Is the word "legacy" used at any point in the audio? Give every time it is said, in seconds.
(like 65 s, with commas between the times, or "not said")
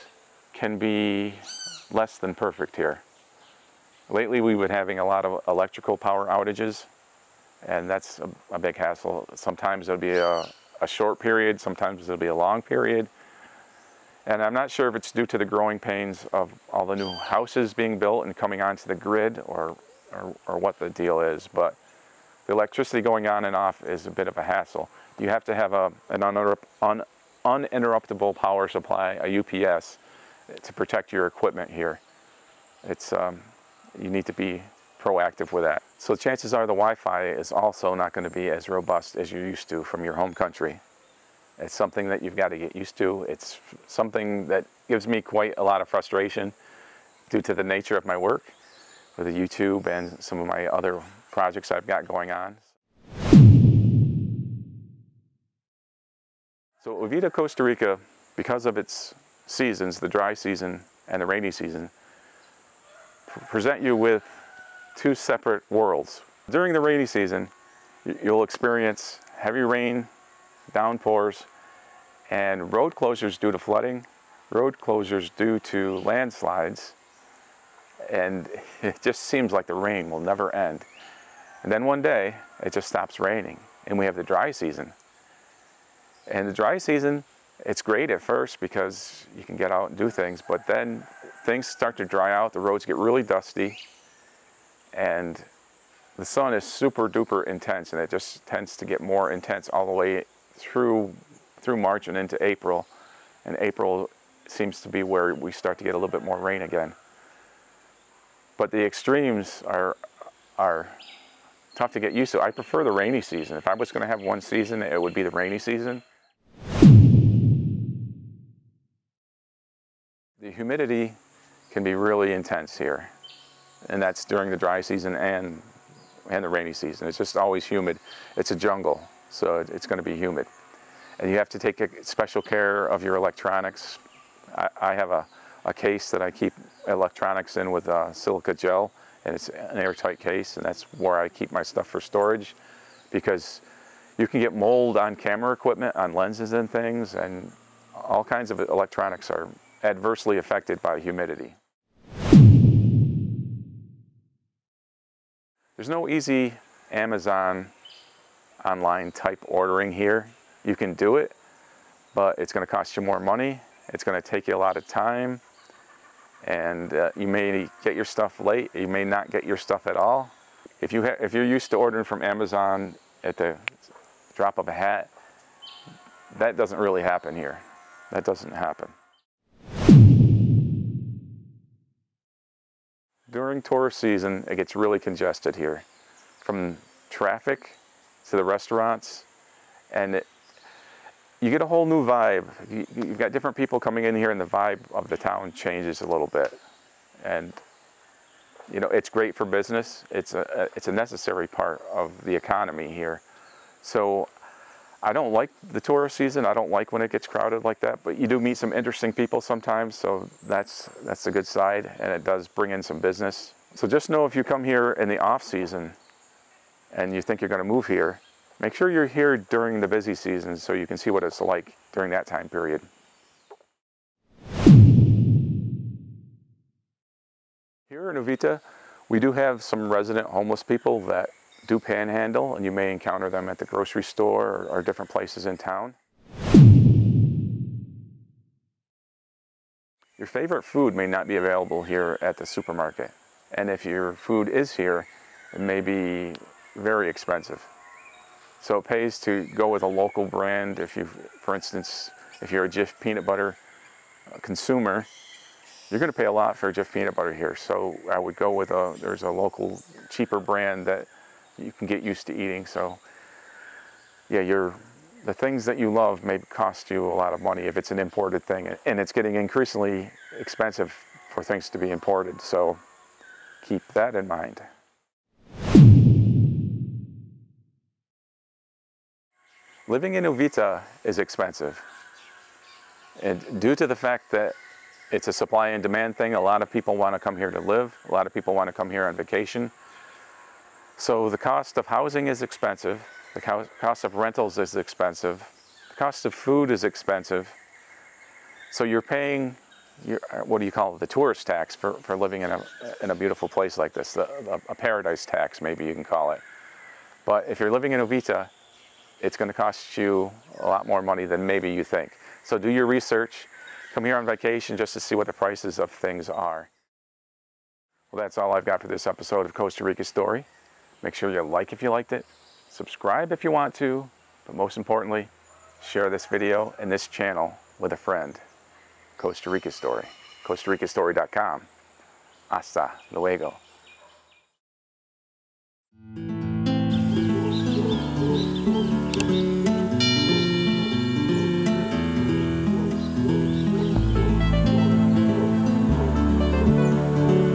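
not said.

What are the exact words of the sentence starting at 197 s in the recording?
And you know, it's great for business.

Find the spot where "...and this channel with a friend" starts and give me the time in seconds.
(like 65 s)
326 s.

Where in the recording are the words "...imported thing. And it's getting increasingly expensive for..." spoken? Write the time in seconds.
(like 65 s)
267 s.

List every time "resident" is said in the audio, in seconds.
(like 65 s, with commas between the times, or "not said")
229 s.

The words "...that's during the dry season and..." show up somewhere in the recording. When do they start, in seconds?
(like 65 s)
124 s.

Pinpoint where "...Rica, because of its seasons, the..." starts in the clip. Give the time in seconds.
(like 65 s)
57 s.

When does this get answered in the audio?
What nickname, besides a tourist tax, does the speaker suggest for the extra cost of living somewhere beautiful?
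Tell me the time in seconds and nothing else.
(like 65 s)
304 s.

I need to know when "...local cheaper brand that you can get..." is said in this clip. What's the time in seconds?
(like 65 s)
259 s.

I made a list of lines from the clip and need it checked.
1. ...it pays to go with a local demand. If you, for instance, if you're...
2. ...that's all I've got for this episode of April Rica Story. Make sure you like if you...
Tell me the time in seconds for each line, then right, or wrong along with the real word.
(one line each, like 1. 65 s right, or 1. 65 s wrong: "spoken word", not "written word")
1. 248 s wrong: "brand", not "demand"
2. 318 s wrong: "Costa", not "April".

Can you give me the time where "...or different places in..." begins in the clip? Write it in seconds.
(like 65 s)
234 s.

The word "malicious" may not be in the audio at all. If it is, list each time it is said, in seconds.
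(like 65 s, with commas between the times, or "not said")
not said.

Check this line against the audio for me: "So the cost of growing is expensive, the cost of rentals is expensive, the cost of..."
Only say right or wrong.
wrong.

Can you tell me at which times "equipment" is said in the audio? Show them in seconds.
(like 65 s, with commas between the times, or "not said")
31 s, 145 s.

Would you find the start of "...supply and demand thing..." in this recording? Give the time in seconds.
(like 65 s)
285 s.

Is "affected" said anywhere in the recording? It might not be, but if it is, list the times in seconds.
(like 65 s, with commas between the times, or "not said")
150 s.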